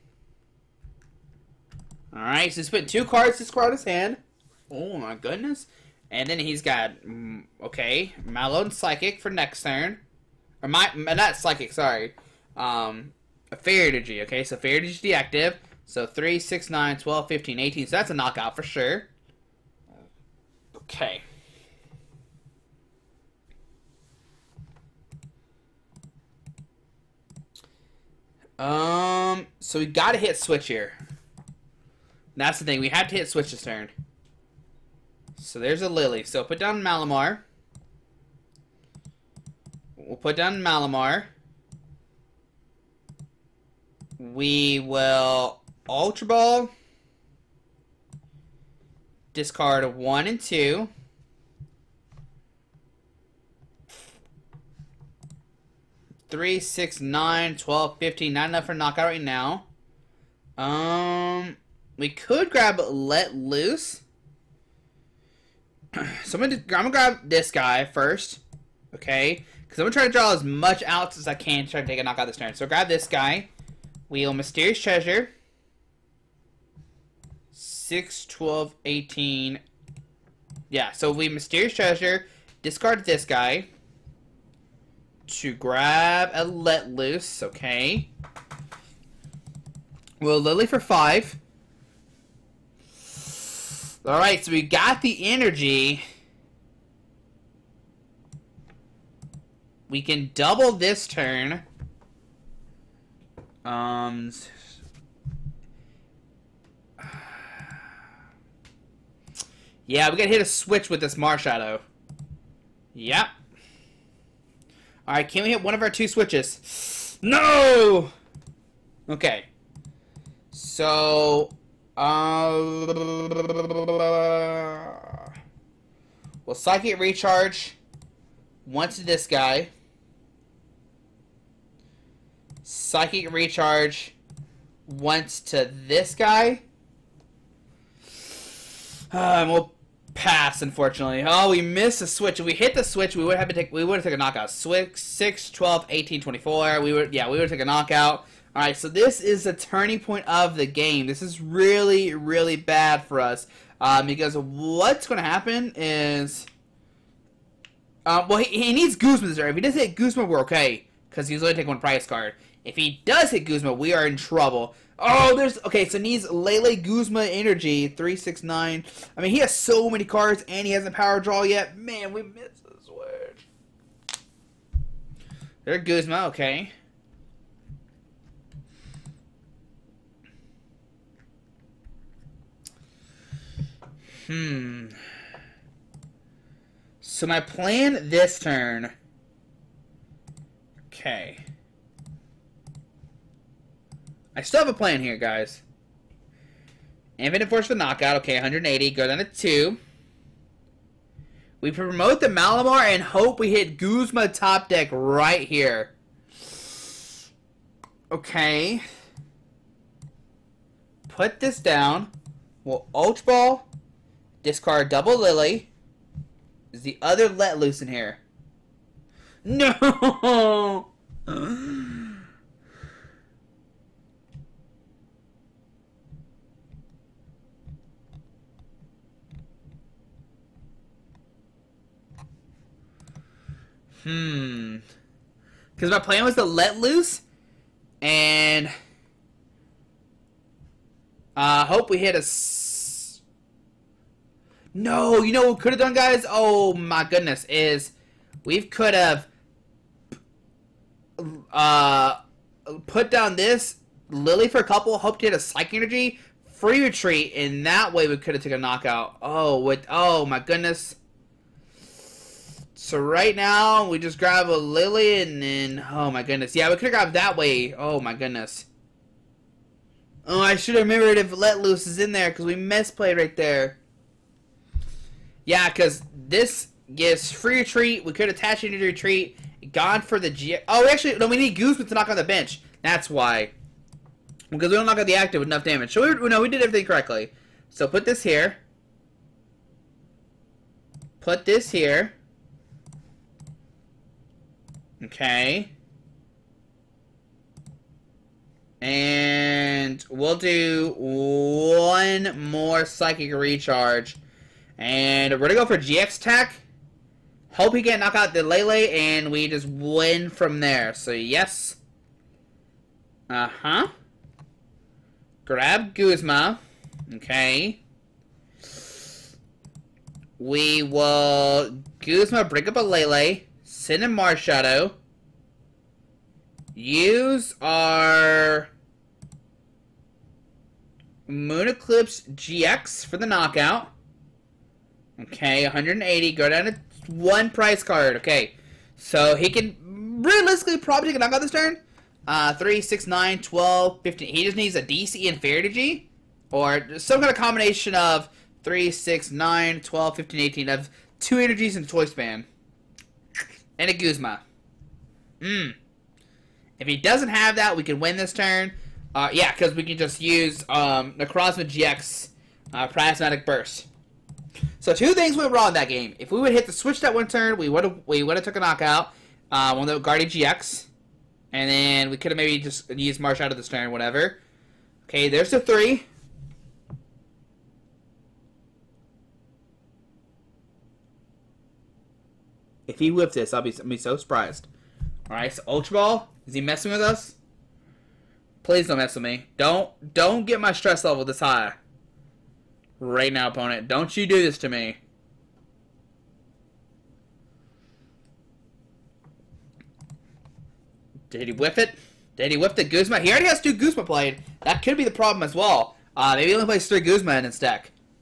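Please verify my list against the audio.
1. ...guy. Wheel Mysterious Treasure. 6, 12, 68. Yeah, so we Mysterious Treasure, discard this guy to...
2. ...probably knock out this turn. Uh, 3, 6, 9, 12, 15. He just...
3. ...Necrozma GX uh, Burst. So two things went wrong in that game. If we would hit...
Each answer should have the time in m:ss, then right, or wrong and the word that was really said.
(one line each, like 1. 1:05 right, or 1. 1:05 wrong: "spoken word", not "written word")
1. 1:13 wrong: "18", not "68"
2. 5:40 right
3. 6:01 right.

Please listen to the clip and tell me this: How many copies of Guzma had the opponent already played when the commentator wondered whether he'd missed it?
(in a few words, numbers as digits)
2.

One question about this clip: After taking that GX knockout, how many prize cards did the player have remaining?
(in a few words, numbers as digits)
1.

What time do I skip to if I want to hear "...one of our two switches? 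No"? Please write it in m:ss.
1:55.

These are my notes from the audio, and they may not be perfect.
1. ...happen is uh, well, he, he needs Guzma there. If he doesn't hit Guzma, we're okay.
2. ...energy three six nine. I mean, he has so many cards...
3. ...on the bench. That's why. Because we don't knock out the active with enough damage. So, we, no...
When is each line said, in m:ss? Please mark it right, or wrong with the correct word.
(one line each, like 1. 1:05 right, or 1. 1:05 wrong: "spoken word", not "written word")
1. 2:35 right
2. 2:47 right
3. 4:42 right.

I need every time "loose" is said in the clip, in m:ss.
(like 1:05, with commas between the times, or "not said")
1:03, 1:26, 3:37, 3:56, 4:31.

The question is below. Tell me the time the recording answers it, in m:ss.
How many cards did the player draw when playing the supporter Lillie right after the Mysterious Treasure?
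1:30.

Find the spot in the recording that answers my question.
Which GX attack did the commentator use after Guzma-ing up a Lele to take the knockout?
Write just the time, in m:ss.
5:31.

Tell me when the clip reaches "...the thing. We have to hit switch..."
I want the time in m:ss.
0:32.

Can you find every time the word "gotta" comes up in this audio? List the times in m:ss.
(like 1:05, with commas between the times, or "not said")
0:29, 1:50.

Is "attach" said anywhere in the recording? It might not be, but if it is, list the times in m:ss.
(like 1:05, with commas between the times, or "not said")
4:38.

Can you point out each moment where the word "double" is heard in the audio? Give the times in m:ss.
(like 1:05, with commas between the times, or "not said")
1:40, 3:34.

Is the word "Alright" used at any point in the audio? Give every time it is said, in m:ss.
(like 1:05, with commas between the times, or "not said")
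0:02, 1:34, 1:55, 2:28, 6:25.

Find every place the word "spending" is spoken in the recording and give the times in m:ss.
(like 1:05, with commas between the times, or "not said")
not said.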